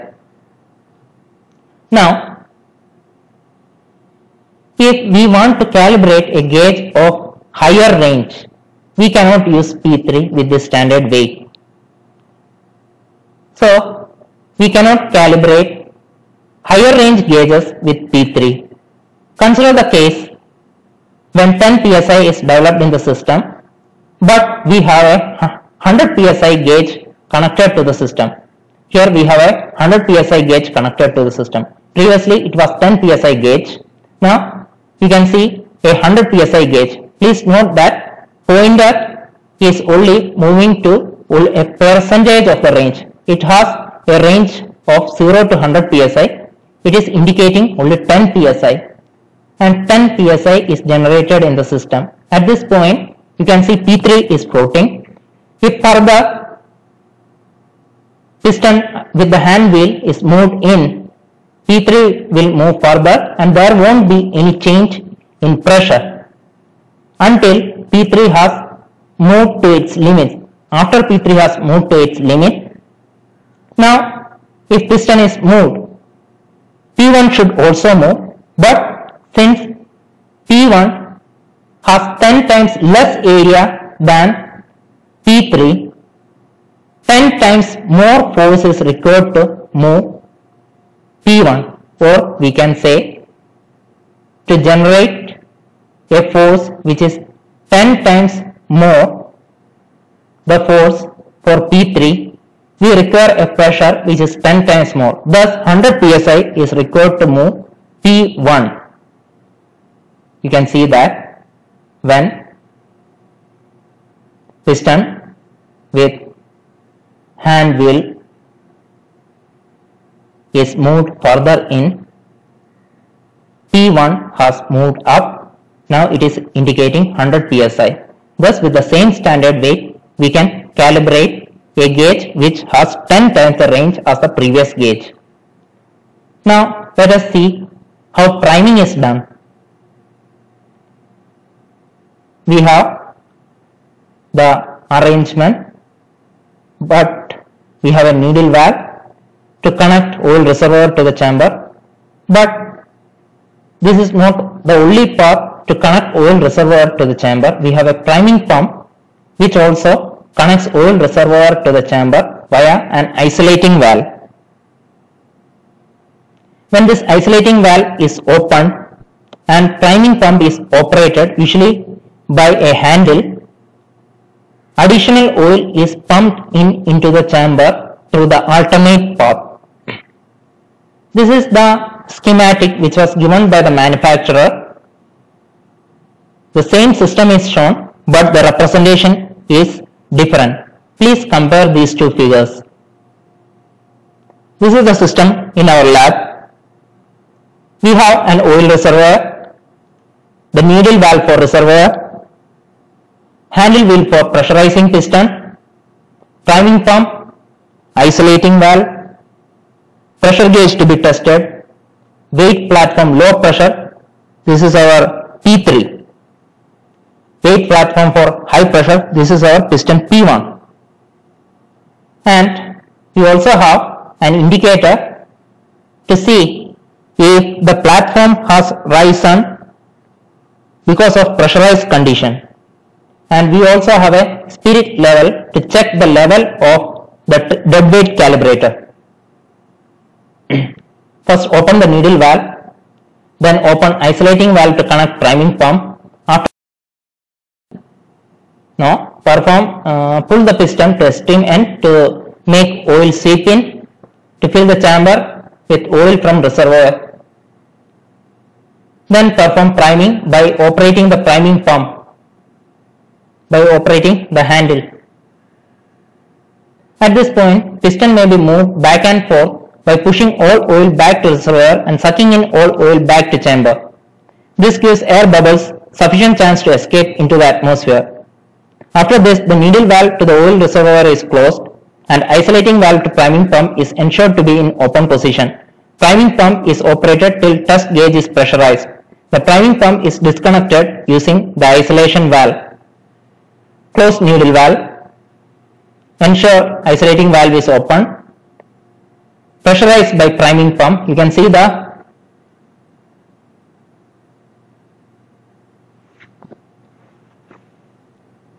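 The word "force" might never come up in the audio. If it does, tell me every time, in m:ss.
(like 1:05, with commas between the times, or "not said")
1:28, 1:36, 1:40.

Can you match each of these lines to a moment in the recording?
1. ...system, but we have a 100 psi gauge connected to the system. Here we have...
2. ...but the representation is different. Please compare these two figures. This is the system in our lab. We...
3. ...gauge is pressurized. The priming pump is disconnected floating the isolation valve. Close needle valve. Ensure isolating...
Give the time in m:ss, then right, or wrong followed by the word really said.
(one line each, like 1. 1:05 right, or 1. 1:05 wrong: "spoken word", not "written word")
1. 0:23 right
2. 3:08 right
3. 4:47 wrong: "using", not "floating".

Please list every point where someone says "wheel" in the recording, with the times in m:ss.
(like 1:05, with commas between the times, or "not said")
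0:59, 1:57, 3:23.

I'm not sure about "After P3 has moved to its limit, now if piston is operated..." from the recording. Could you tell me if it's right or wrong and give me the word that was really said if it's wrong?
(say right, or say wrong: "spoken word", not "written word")
wrong: "moved", not "operated".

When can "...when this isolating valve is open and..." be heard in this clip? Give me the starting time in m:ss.
2:46.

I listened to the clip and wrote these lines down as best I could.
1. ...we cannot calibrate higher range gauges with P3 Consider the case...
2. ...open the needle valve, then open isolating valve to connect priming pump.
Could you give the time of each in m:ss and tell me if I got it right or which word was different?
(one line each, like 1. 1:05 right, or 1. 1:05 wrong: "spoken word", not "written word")
1. 0:14 right
2. 4:01 right.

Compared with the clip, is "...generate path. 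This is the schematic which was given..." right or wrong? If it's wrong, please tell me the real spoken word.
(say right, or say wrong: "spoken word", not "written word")
wrong: "alternate", not "generate".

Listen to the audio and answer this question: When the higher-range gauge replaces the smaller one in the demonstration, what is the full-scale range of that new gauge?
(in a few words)
0 to 100 psi.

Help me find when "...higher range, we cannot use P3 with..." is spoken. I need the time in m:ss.
0:07.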